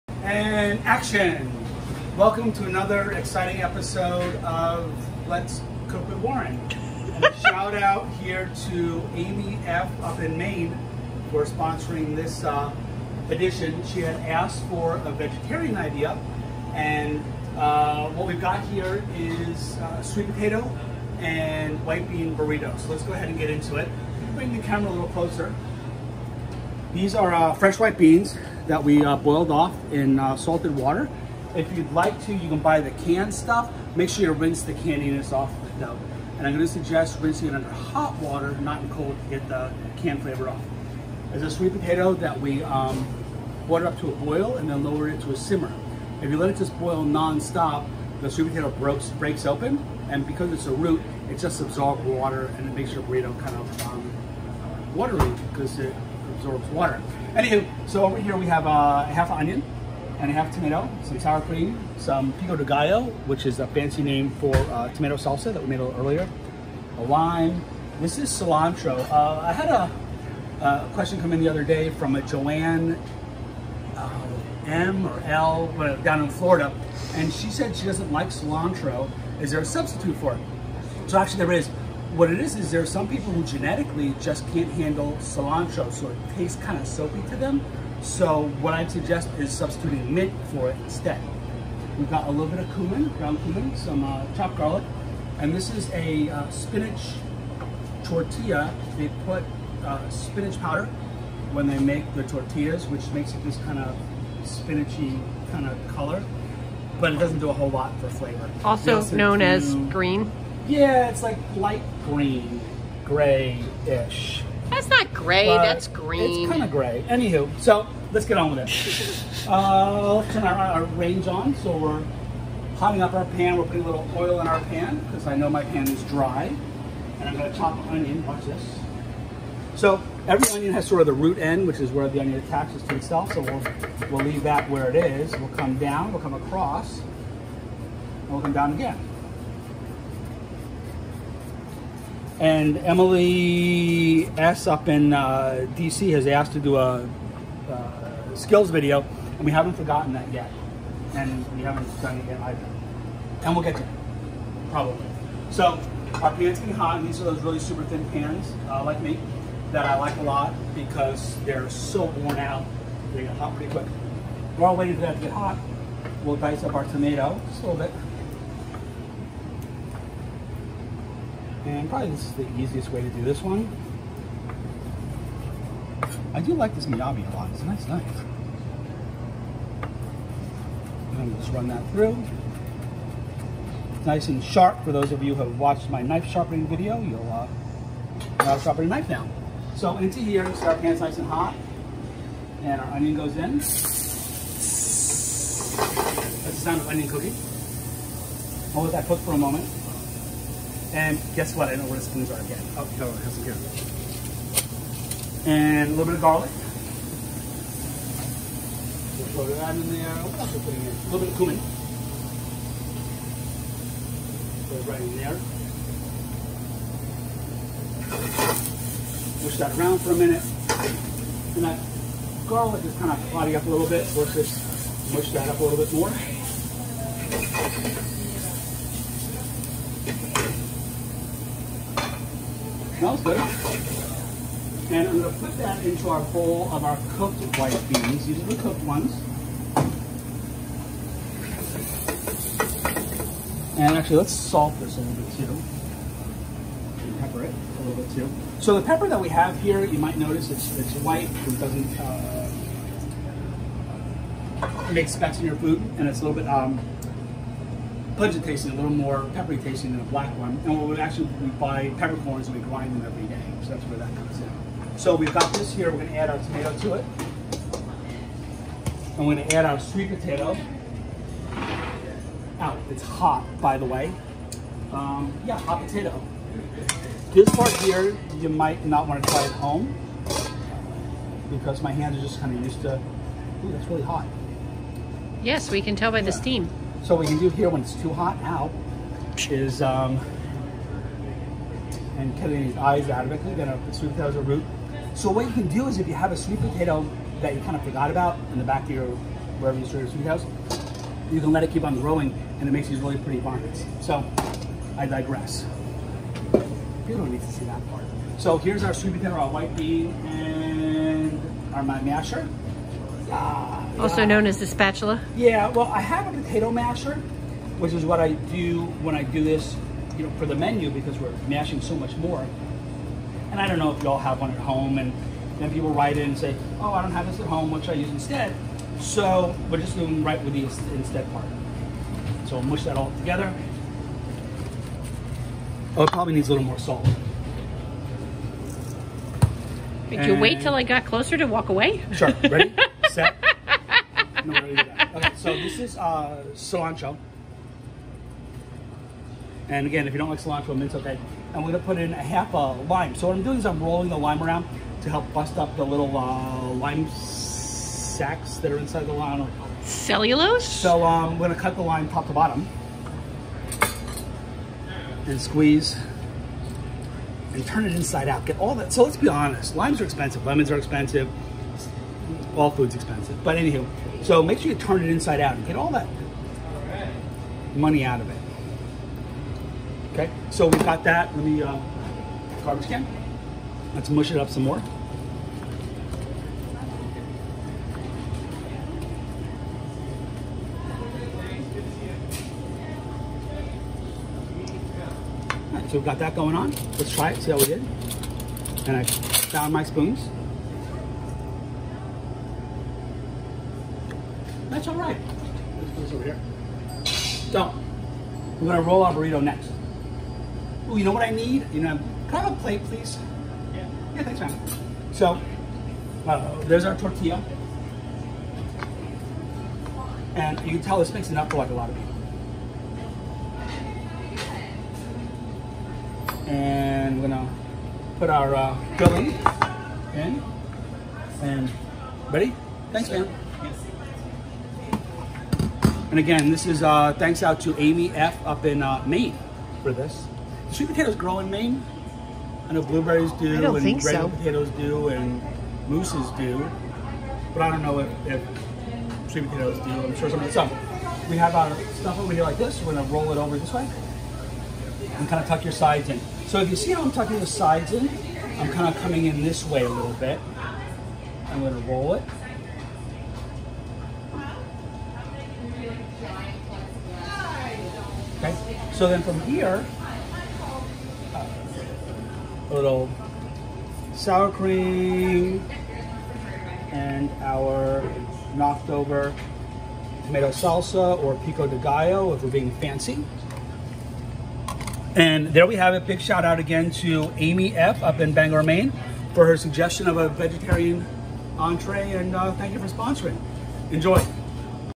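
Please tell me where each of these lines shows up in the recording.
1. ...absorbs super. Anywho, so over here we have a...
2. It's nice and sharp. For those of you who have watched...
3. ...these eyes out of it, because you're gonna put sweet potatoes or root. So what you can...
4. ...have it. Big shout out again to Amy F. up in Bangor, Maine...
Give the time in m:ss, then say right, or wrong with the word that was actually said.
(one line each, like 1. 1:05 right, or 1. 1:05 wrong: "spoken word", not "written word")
1. 0:56 wrong: "water", not "super"
2. 3:03 right
3. 4:52 right
4. 8:05 right.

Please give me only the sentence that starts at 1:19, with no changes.
Is there a substitute for it?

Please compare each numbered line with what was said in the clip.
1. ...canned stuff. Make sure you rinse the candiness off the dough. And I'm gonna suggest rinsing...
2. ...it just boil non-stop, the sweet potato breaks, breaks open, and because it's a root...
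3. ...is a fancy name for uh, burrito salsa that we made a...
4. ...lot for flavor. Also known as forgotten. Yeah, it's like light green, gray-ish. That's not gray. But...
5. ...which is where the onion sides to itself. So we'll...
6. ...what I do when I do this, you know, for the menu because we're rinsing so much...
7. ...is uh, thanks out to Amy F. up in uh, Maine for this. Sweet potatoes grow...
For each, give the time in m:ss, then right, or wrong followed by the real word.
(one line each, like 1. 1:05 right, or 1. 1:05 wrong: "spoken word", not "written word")
1. 0:33 right
2. 0:46 right
3. 1:03 wrong: "tomato", not "burrito"
4. 1:47 wrong: "green", not "forgotten"
5. 2:11 wrong: "attaches", not "sides"
6. 5:18 wrong: "mashing", not "rinsing"
7. 7:16 right.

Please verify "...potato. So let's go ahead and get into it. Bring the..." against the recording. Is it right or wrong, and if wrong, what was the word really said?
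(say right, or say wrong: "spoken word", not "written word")
wrong: "burrito", not "potato".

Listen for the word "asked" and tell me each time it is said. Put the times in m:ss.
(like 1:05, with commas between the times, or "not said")
0:14, 2:26.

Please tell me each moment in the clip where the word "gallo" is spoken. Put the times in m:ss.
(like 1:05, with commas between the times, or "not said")
1:02, 8:01.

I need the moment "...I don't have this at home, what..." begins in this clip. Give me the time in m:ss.
5:26.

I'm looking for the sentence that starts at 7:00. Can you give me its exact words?
And you can tell this makes enough for like a lot of people.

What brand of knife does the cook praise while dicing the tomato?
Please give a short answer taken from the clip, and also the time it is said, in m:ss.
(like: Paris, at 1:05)
Miyabi, at 2:56.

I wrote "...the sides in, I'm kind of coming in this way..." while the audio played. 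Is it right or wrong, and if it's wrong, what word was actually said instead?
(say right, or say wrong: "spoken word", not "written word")
right.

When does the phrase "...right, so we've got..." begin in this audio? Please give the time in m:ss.
6:35.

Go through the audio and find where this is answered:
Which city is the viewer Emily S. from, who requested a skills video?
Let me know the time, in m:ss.
2:25.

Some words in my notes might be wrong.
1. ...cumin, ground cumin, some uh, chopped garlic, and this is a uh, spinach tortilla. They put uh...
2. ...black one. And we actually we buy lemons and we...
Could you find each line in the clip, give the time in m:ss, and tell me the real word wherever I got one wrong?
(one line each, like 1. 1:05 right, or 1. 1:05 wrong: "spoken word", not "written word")
1. 1:32 right
2. 4:20 wrong: "peppercorns", not "lemons".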